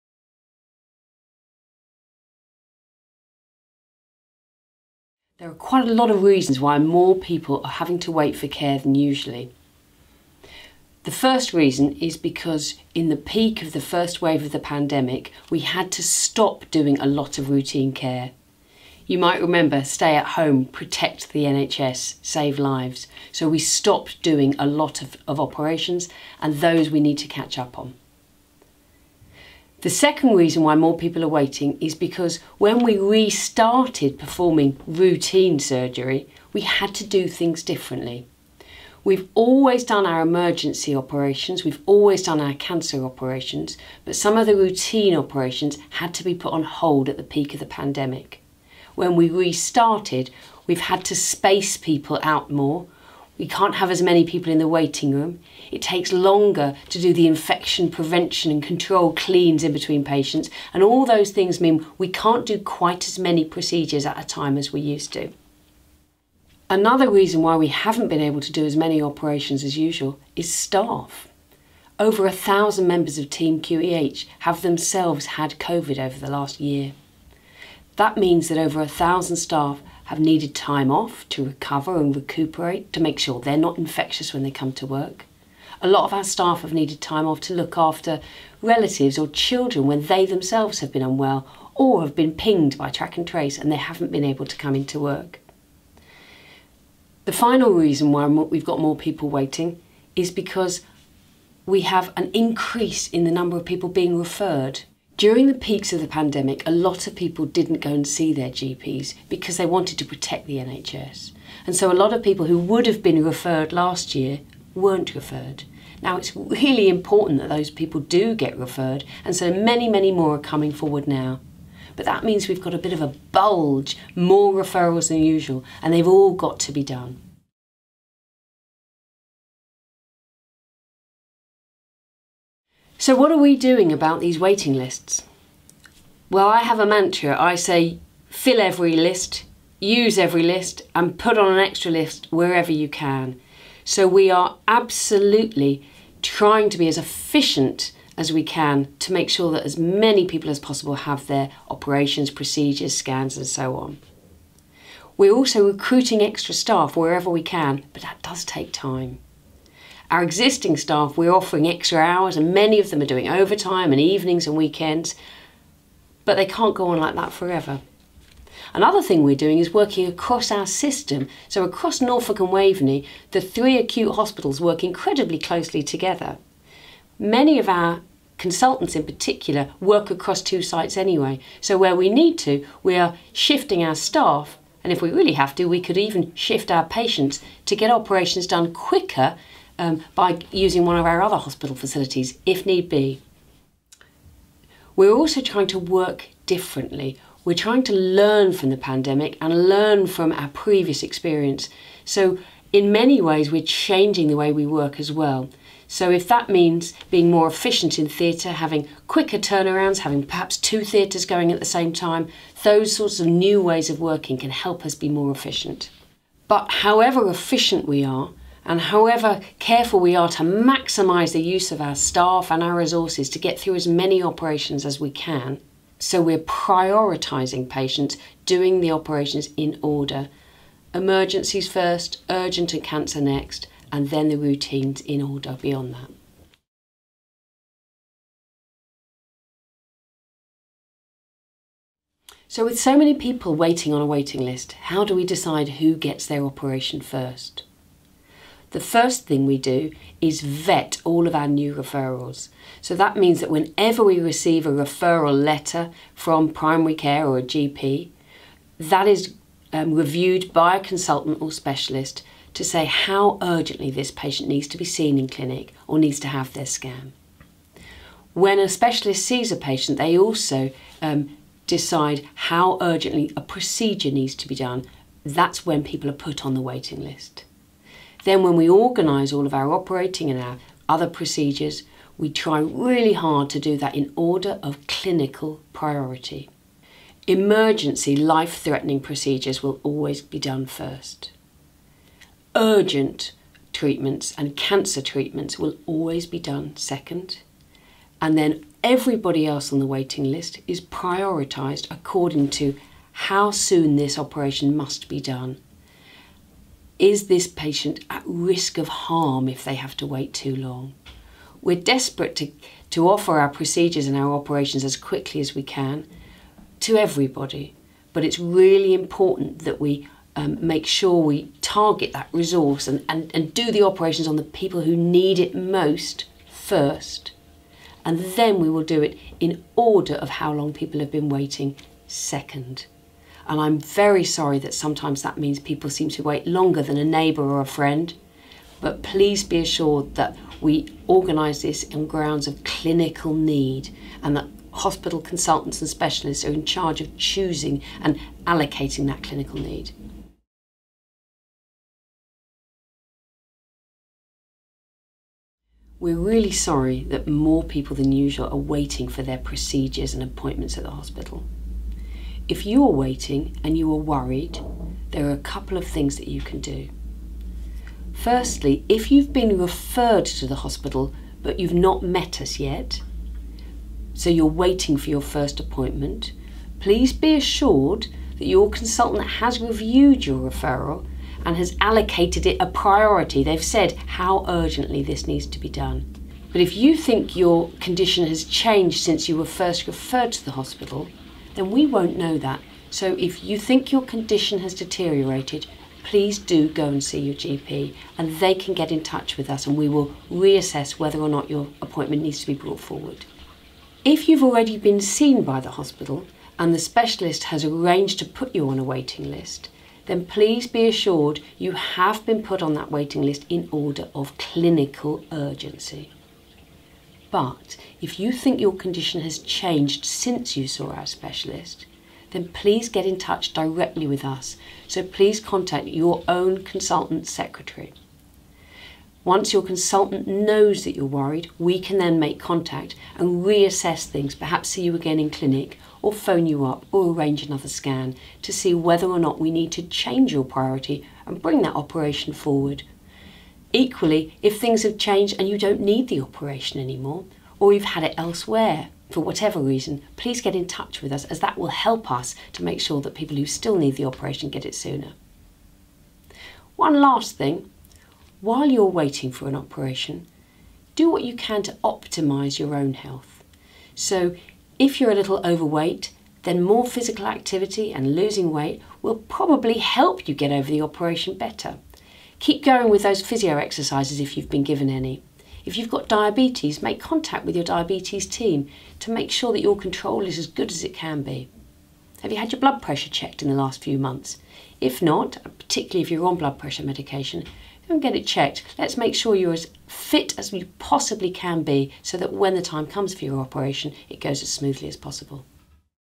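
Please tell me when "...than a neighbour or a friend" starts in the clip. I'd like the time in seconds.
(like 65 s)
336 s.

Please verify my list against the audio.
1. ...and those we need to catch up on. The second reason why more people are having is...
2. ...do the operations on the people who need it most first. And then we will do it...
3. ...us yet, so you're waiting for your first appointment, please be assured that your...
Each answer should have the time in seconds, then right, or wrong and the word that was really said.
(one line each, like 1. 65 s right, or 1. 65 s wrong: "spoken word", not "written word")
1. 26 s wrong: "waiting", not "having"
2. 323 s right
3. 372 s right.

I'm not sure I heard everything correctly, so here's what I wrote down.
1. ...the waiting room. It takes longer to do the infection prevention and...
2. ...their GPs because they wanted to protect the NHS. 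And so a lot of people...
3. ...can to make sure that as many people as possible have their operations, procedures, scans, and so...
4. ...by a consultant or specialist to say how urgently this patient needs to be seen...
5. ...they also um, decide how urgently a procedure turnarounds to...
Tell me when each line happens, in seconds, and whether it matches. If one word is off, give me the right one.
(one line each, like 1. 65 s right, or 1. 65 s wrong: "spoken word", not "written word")
1. 54 s right
2. 108 s right
3. 148 s right
4. 260 s right
5. 269 s wrong: "needs", not "turnarounds".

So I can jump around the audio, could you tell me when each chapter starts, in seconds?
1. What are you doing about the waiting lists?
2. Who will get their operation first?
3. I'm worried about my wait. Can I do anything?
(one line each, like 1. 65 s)
1. 127 s
2. 236 s
3. 350 s.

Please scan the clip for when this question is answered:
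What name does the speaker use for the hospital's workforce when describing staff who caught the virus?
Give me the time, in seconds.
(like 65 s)
73 s.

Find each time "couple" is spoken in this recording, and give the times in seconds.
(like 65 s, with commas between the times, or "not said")
365 s.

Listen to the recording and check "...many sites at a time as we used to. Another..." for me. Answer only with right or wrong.
wrong.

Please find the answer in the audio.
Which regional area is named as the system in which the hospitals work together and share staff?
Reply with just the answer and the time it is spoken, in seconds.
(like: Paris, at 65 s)
Norfolk and Waveney, at 172 s.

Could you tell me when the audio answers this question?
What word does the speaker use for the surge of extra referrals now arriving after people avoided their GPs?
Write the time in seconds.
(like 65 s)
123 s.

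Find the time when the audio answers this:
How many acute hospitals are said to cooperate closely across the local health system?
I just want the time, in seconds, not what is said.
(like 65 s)
173 s.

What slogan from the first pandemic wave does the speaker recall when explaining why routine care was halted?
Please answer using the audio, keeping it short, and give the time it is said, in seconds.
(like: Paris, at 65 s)
Stay at home, protect the NHS, save lives, at 19 s.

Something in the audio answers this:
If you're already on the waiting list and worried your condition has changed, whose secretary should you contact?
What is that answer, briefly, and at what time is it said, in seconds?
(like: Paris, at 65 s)
Your own consultant, at 425 s.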